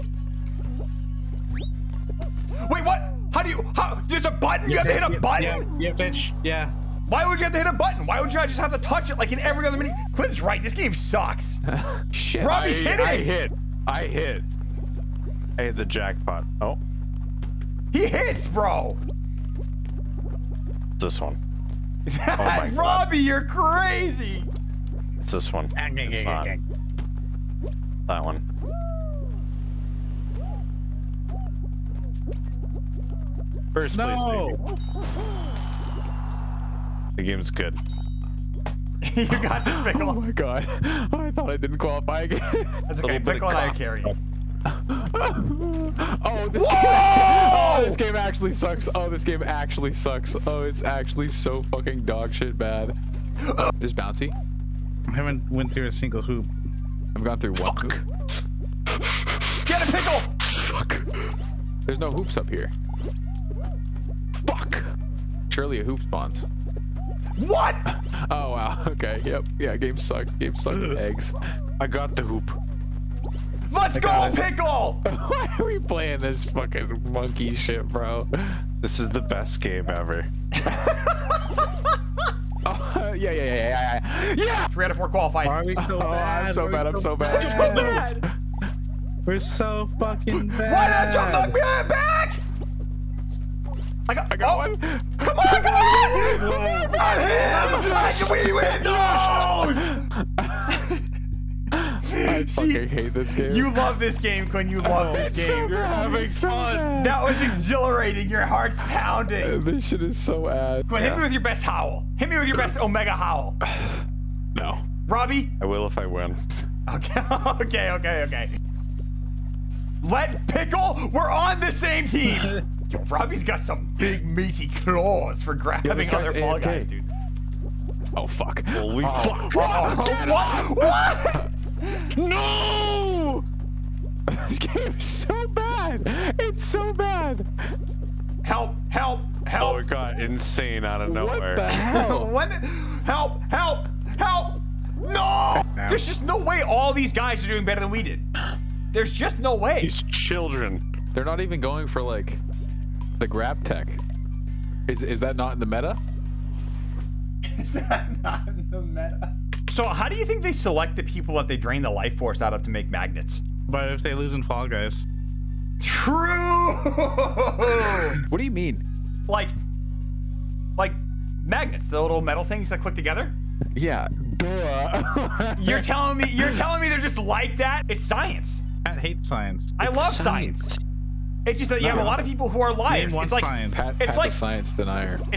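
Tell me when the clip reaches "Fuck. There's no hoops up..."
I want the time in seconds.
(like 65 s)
60 s.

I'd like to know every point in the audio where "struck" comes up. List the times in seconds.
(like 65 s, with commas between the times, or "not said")
not said.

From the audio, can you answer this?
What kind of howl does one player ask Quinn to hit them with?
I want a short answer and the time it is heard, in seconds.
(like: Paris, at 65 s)
Omega howl, at 112 s.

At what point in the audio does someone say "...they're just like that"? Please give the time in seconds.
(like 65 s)
176 s.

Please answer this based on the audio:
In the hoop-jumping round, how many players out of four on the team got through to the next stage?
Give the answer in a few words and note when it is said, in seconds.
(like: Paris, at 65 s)
3, at 84 s.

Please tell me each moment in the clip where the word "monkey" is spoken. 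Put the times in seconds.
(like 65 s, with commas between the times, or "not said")
77 s.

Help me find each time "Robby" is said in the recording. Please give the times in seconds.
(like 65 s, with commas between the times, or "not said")
12 s, 22 s, 115 s, 123 s.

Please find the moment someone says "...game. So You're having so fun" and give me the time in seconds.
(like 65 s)
105 s.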